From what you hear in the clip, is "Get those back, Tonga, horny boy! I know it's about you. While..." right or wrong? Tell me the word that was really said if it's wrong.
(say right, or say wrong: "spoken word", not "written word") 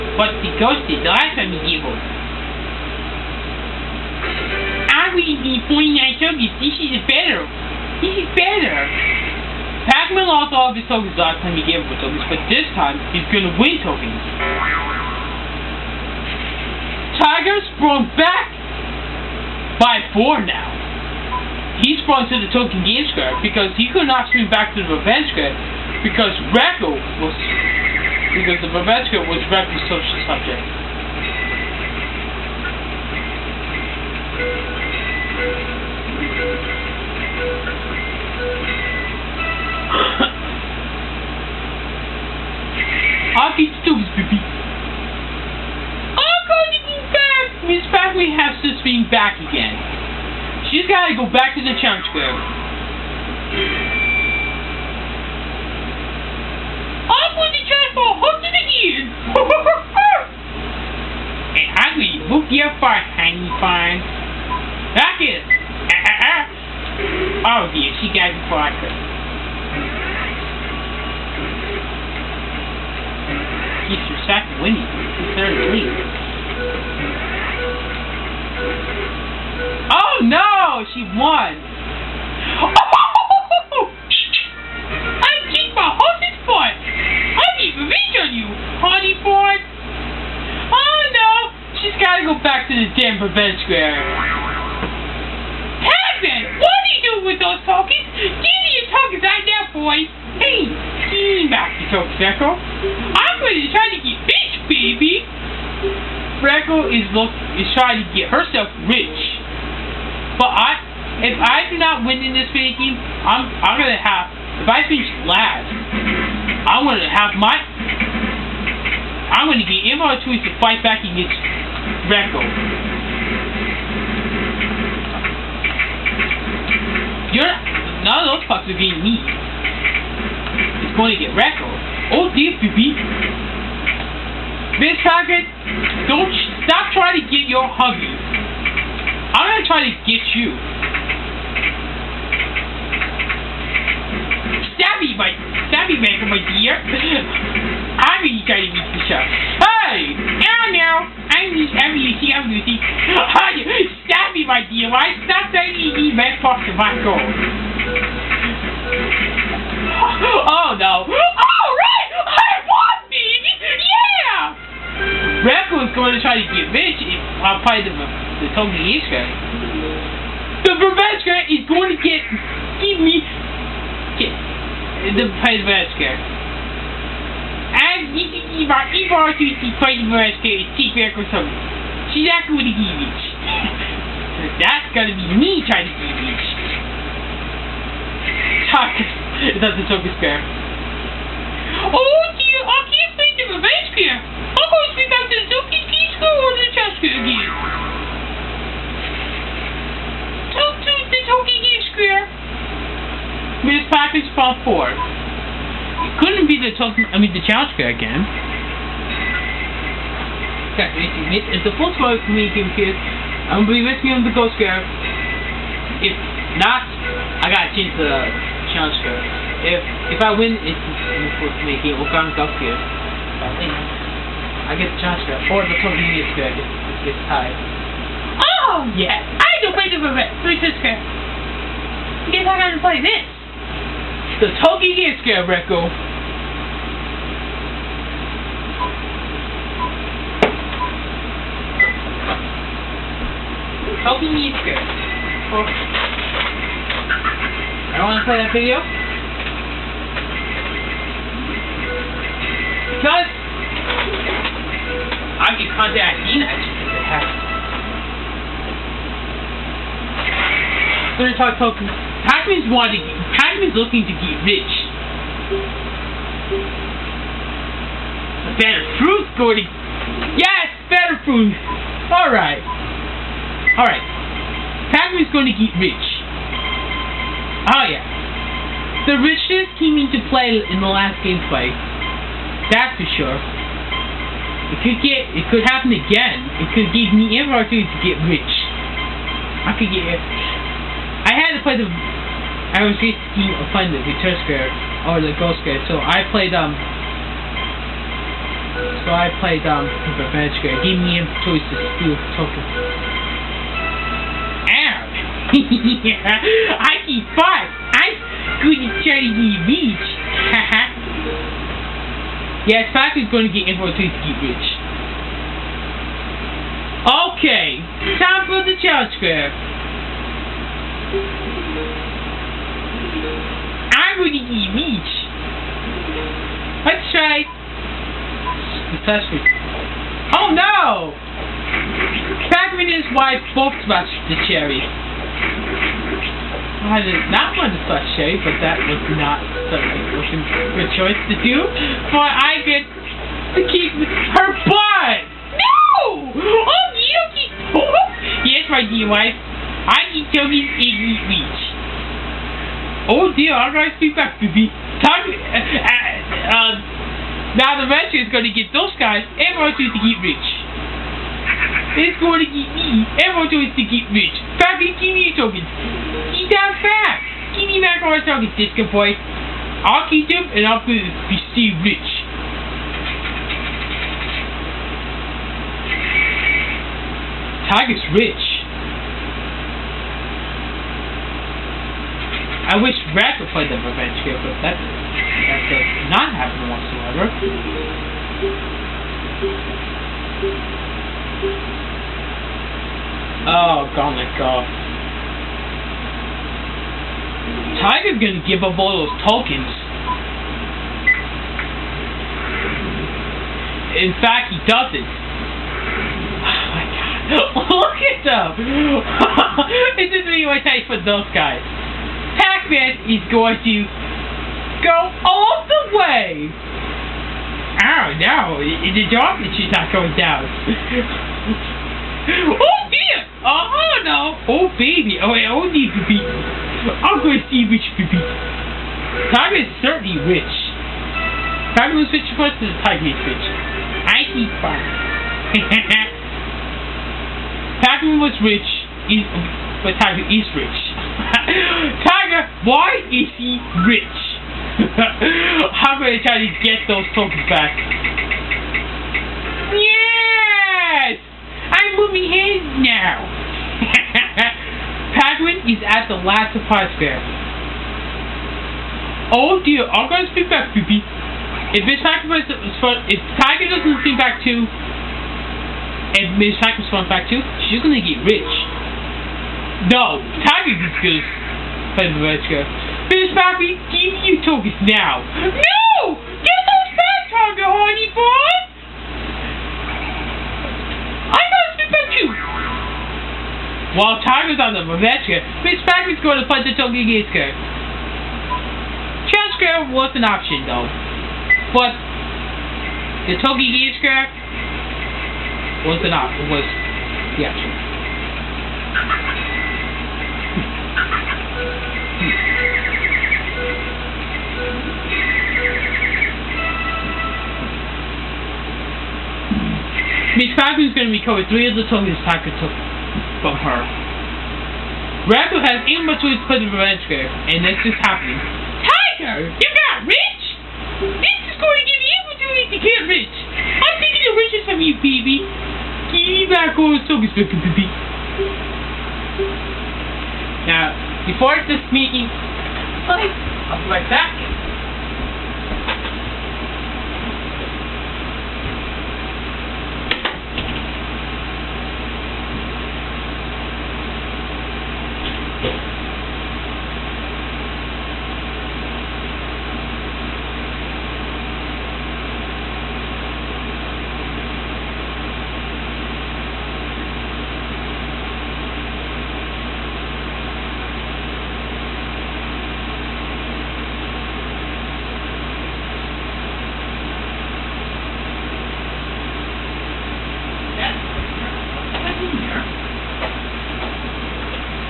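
right.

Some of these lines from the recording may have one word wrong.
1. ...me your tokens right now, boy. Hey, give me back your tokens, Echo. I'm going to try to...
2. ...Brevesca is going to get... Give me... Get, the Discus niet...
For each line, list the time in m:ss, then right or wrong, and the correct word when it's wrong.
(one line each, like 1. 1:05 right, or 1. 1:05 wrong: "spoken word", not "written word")
1. 1:38 right
2. 2:50 wrong: "Brevesca", not "Discus".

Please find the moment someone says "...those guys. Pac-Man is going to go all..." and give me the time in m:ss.
6:51.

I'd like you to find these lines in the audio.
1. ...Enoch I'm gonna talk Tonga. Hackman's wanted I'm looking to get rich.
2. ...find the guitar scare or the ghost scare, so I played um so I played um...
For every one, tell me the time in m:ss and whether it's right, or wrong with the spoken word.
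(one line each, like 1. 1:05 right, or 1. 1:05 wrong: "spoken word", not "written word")
1. 4:16 wrong: "Toki", not "Tonga"
2. 4:53 right.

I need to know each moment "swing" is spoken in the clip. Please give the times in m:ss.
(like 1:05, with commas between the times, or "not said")
0:24, 0:48.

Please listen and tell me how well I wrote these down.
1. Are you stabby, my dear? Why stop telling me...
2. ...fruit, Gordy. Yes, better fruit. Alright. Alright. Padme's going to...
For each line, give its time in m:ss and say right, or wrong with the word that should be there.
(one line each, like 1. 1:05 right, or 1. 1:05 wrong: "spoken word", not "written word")
1. 2:33 right
2. 4:29 right.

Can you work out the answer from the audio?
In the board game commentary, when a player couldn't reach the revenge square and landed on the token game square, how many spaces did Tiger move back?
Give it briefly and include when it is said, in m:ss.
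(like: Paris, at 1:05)
4, at 0:20.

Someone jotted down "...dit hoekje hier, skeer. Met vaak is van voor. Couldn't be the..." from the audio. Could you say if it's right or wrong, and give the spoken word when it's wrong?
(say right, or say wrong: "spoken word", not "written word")
right.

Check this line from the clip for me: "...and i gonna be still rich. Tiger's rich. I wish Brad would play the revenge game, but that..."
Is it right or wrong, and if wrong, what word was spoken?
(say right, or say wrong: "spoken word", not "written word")
right.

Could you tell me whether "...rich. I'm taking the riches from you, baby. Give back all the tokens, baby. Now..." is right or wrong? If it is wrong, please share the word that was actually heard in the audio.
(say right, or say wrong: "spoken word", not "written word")
right.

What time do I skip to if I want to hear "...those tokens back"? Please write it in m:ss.
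7:26.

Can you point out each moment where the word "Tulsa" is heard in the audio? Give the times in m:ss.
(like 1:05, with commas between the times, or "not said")
3:26.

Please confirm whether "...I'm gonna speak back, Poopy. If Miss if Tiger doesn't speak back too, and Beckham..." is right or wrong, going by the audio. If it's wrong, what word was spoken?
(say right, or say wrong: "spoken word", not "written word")
wrong: "Miss", not "Beckham".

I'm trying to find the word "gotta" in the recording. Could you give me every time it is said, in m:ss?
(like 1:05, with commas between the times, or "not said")
1:32, 3:37, 3:52.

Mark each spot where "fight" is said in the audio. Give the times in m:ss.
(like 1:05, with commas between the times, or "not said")
2:00, 4:41.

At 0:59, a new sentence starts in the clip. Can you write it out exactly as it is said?
and I'm gonna book you fine, honey fine.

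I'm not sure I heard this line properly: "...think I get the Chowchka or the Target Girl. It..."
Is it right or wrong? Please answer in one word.
wrong.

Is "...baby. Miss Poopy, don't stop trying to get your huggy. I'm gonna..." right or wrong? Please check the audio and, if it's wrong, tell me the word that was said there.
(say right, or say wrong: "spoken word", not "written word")
wrong: "Target", not "Poopy".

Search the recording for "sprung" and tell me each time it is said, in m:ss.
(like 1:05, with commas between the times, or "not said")
0:17, 0:22.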